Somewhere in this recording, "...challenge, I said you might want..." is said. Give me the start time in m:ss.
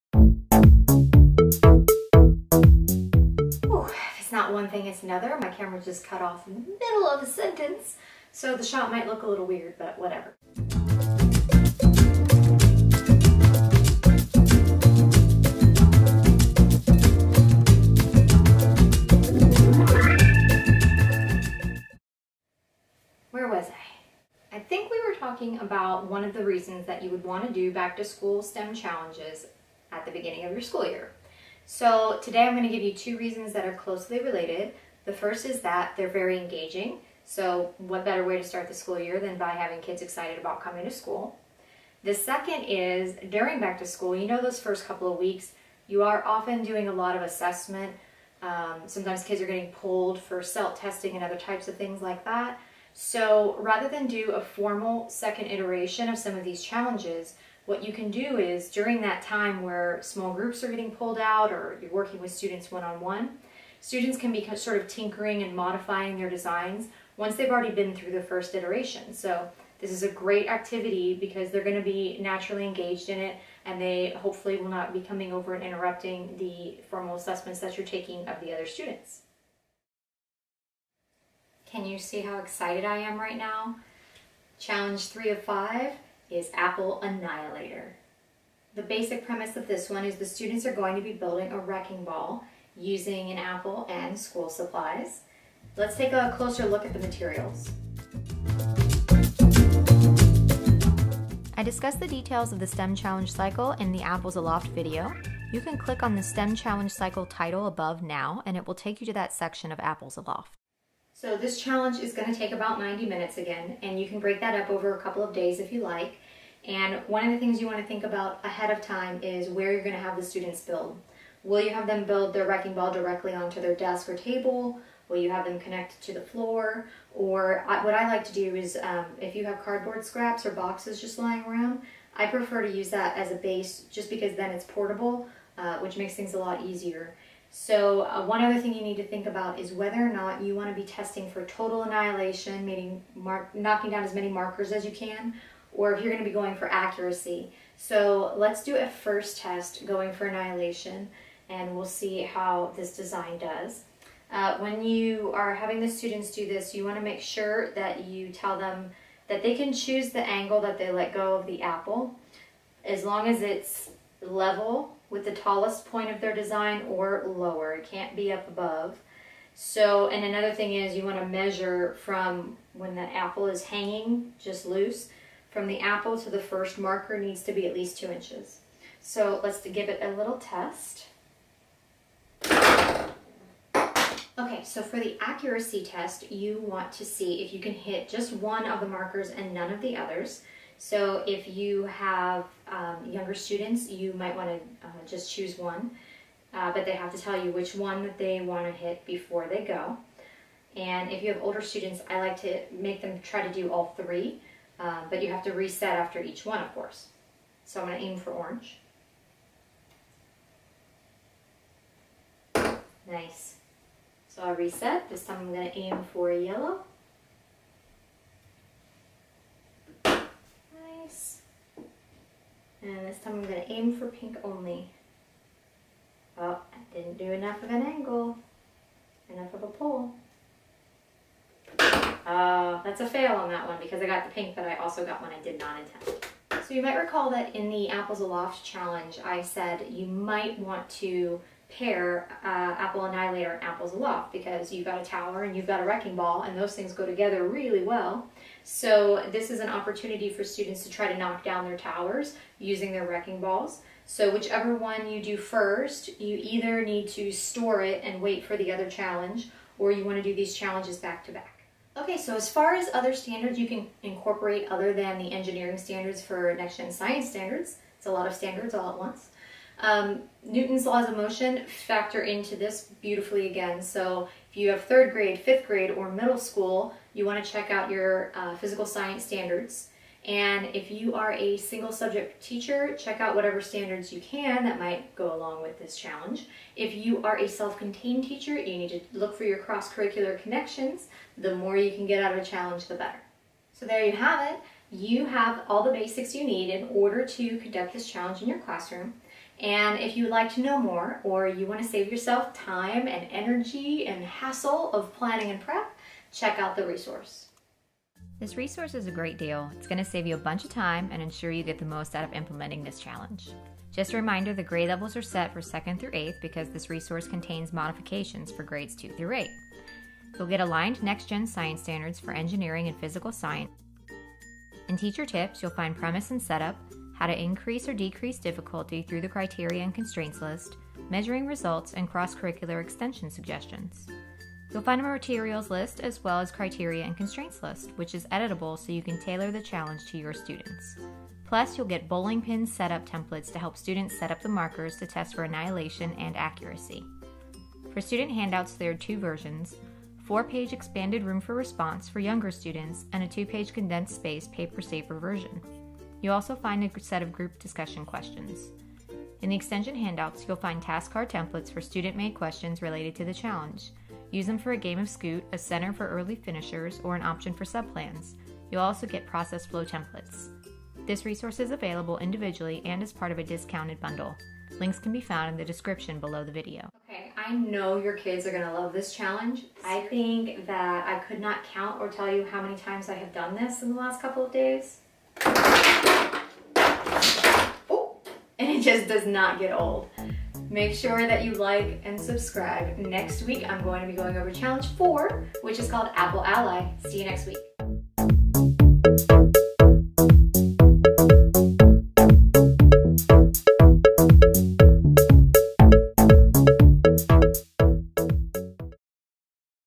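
3:58.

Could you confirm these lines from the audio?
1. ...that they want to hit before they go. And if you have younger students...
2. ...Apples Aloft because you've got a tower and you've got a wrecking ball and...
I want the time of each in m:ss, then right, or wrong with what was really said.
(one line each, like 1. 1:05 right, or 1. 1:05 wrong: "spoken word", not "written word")
1. 3:18 wrong: "older", not "younger"
2. 4:03 right.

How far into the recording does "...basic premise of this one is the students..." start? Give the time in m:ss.
1:28.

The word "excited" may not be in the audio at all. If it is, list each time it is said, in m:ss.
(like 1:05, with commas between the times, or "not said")
0:40, 1:22.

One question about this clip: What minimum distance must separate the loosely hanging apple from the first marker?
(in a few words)
2 inches.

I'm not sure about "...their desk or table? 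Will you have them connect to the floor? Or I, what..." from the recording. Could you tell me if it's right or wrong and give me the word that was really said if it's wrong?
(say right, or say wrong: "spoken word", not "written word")
right.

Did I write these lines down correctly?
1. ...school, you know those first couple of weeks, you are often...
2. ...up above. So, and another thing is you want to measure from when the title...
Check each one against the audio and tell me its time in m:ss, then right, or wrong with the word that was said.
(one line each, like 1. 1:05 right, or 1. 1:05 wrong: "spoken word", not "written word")
1. 0:43 right
2. 2:48 wrong: "apple", not "title".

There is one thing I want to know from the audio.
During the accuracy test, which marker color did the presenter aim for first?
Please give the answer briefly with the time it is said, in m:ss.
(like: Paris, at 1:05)
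orange, at 3:28.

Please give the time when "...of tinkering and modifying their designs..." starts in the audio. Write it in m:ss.
1:04.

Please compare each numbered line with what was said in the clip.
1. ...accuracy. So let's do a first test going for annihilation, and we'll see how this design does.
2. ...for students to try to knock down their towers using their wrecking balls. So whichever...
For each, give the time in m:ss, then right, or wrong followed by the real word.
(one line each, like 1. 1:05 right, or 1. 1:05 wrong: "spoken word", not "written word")
1. 2:26 right
2. 4:10 right.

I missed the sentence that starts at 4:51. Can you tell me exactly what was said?
The more you can get out of a challenge, the better.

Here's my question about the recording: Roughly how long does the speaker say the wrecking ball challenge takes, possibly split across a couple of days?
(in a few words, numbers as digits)
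90 minutes.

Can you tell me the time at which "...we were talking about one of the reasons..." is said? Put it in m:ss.
0:24.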